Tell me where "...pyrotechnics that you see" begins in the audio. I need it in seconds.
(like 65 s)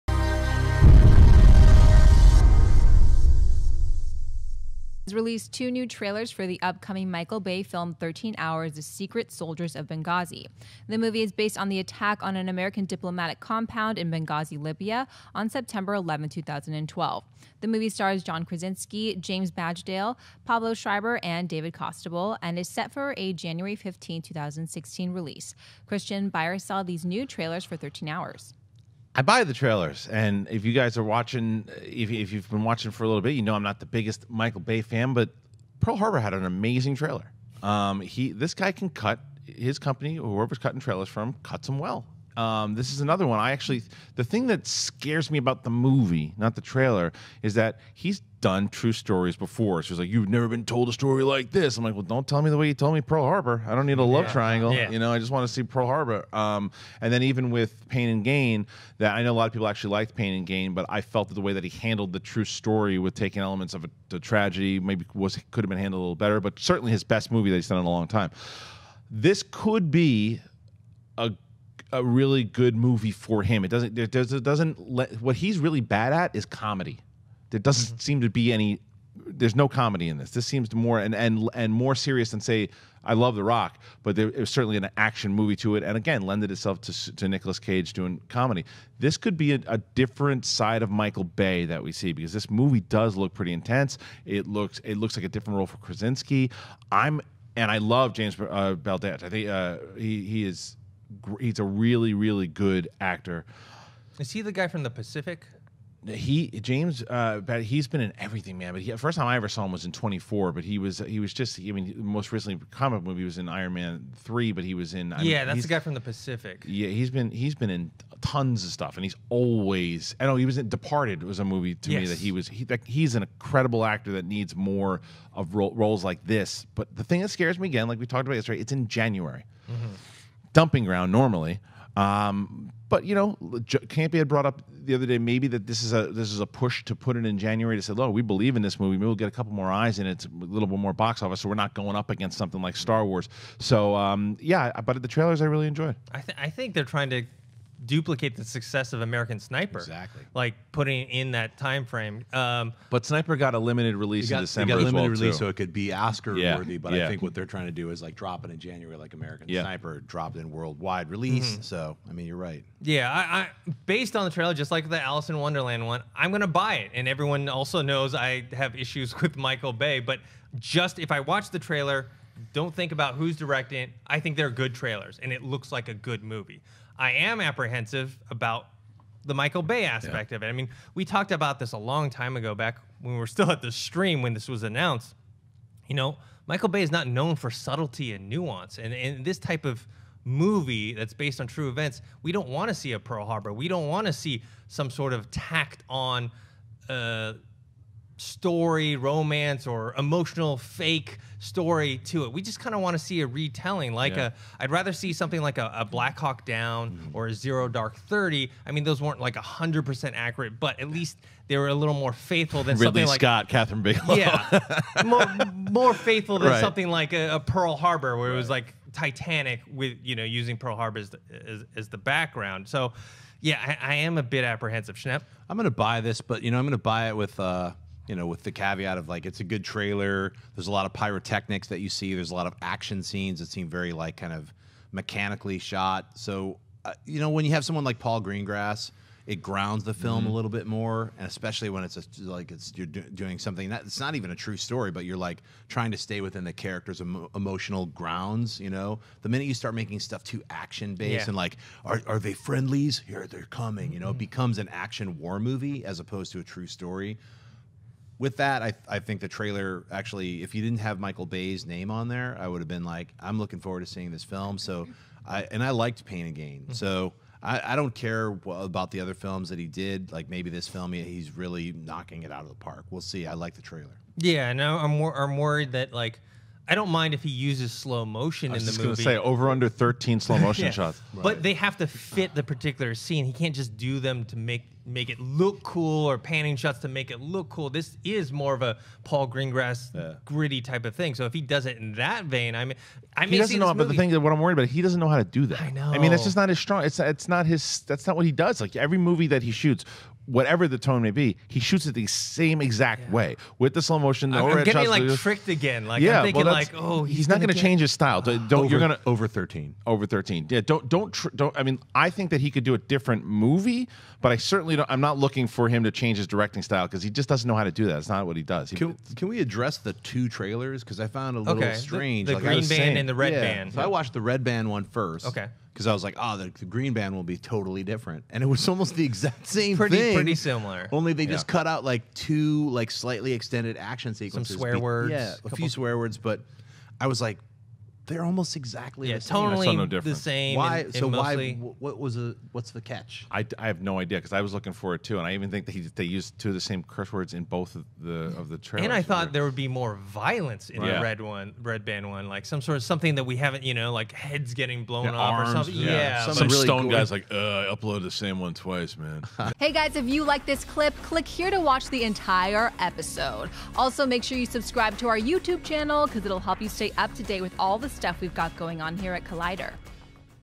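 230 s.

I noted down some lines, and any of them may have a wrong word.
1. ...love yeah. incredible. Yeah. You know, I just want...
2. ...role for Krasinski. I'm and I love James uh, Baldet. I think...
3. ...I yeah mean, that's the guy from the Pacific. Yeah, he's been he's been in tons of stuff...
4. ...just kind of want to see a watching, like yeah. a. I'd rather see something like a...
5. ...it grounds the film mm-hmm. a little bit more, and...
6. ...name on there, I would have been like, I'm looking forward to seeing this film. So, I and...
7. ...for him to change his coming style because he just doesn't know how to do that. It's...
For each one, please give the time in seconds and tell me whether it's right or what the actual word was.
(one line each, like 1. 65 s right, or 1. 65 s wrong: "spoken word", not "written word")
1. 54 s wrong: "triangle", not "incredible"
2. 95 s right
3. 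115 s right
4. 202 s wrong: "retelling", not "watching"
5. 239 s right
6. 261 s right
7. 315 s wrong: "directing", not "coming".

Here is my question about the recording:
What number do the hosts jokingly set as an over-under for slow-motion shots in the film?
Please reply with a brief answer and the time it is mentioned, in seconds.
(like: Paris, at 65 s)
13, at 279 s.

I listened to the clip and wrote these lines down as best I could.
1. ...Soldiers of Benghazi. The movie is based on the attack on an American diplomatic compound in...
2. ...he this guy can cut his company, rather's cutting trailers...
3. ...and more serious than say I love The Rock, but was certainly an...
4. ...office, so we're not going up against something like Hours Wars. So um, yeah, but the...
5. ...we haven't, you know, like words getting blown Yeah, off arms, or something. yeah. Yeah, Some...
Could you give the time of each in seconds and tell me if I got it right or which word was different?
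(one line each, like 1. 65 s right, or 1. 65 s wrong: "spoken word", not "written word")
1. 9 s right
2. 37 s wrong: "whoever", not "rather"
3. 81 s right
4. 141 s wrong: "Star", not "Hours"
5. 353 s wrong: "heads", not "words".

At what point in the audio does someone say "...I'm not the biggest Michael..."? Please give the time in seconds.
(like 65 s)
33 s.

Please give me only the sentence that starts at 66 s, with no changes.
But certainly his best movie that he's done in a long time.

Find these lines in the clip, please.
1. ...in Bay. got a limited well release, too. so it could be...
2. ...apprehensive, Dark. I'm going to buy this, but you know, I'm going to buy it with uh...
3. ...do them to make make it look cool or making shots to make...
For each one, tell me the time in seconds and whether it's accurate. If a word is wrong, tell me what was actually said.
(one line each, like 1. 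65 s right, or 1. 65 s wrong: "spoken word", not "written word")
1. 154 s wrong: "December", not "Bay"
2. 224 s wrong: "Schnepp", not "Dark"
3. 283 s wrong: "panning", not "making".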